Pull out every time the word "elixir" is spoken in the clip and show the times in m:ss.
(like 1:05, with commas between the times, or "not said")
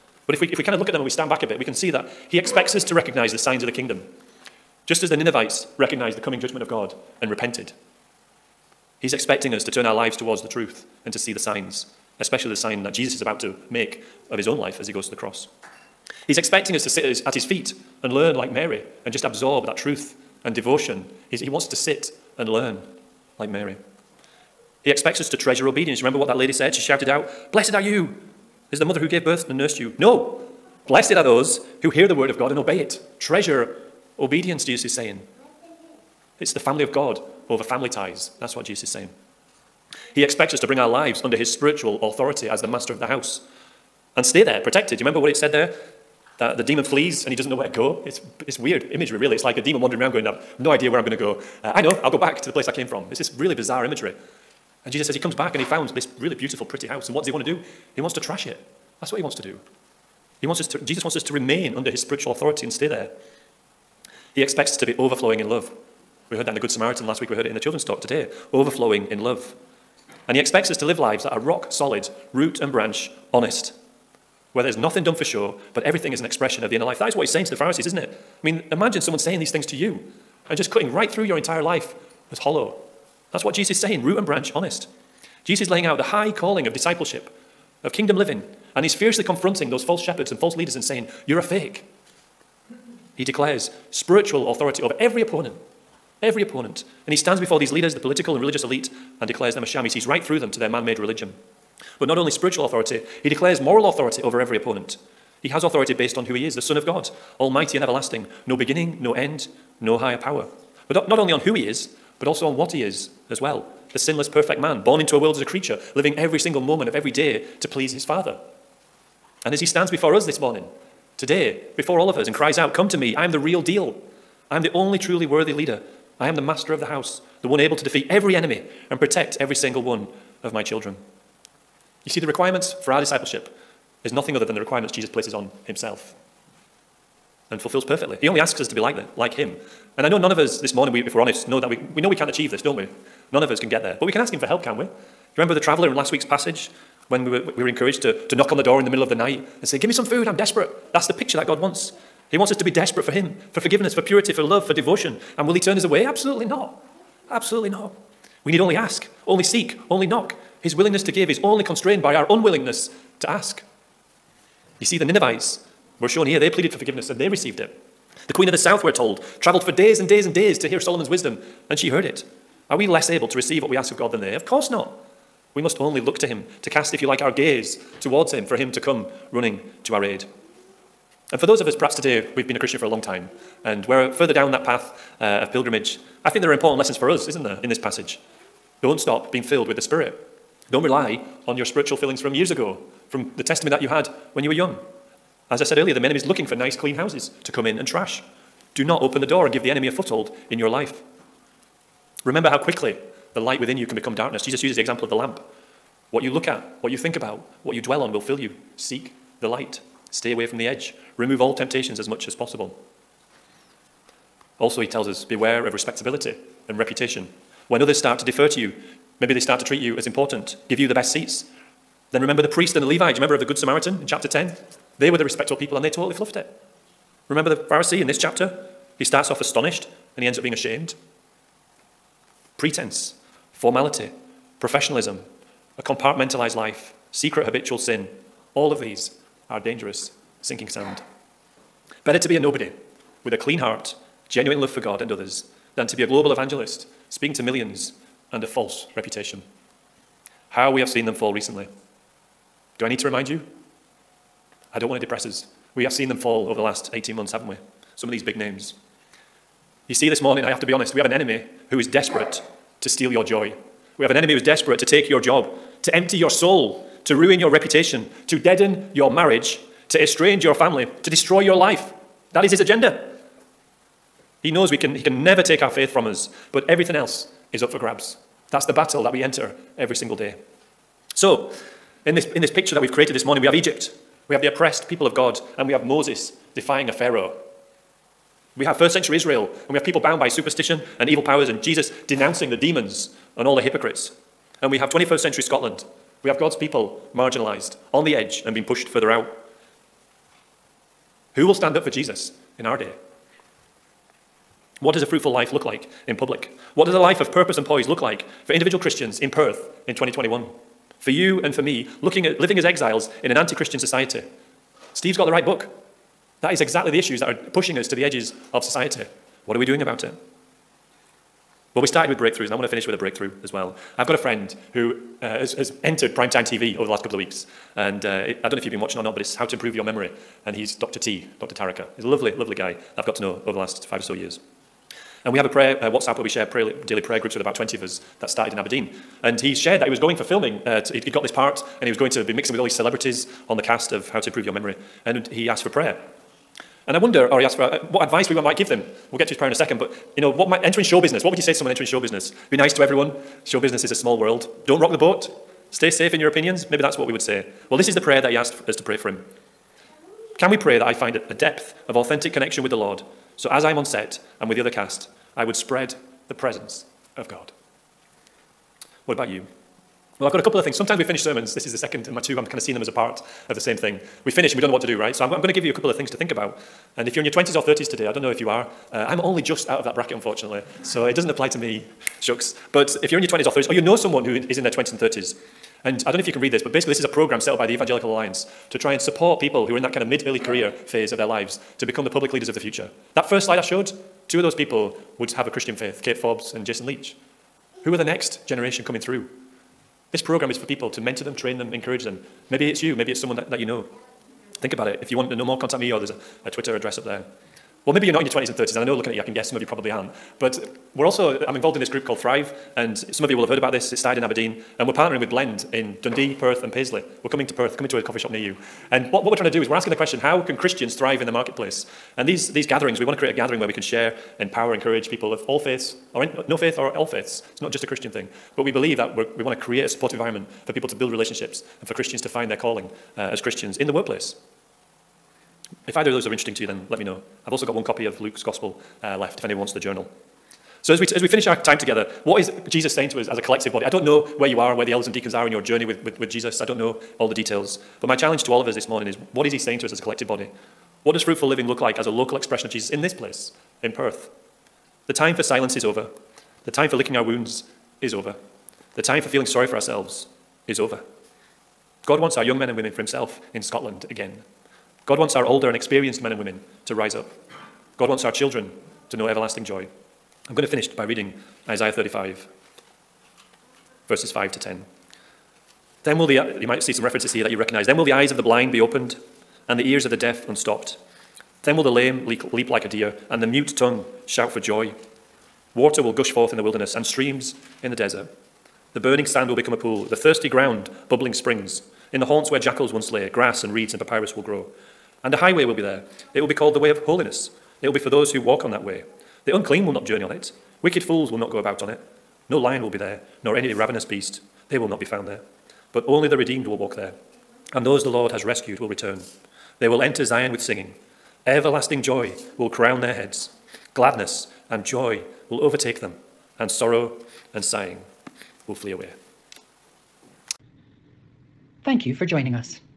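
not said.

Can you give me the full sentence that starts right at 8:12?
In the haunts where jackals once lay, grass and reeds and papyrus will grow.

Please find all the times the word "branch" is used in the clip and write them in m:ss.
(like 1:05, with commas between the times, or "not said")
1:12, 1:24.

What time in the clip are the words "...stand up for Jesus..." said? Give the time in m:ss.
5:01.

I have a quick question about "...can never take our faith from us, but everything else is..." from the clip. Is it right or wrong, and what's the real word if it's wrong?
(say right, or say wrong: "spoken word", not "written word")
right.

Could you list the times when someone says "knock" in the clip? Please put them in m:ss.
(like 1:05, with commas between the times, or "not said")
2:28, 2:40.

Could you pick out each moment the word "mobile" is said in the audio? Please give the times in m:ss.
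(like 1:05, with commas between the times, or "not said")
not said.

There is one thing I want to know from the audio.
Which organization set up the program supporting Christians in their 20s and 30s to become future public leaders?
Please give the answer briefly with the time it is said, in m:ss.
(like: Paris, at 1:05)
Evangelical Alliance, at 6:27.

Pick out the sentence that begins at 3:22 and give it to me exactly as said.
Remember how quickly the light within you can become darkness.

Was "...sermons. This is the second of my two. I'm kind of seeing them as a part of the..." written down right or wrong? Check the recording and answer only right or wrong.
right.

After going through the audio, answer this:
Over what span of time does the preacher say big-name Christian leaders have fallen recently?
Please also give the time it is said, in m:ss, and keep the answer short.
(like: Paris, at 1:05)
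18 months, at 4:16.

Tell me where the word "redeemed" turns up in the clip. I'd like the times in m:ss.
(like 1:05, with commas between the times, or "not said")
8:26.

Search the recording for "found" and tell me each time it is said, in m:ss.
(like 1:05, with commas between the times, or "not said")
0:55, 8:25.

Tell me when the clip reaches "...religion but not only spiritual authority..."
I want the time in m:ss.
1:40.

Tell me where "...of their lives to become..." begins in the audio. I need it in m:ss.
6:31.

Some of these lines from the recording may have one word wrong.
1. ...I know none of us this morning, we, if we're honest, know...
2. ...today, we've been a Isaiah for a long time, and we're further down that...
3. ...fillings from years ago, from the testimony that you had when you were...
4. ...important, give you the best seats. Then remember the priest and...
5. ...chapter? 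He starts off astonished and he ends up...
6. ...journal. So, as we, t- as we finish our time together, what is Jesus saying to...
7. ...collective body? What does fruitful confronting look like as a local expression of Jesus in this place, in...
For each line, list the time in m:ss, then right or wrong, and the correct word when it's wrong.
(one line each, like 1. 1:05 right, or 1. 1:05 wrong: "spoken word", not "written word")
1. 2:20 right
2. 3:01 wrong: "Christian", not "Isaiah"
3. 3:11 right
4. 3:40 right
5. 3:48 right
6. 7:19 right
7. 7:30 wrong: "living", not "confronting".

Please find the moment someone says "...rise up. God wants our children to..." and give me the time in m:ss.
7:46.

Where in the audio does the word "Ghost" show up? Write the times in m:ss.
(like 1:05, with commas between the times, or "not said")
not said.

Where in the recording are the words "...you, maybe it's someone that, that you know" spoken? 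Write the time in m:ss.
6:42.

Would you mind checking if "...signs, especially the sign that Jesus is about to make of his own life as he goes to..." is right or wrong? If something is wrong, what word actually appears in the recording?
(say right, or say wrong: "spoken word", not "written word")
right.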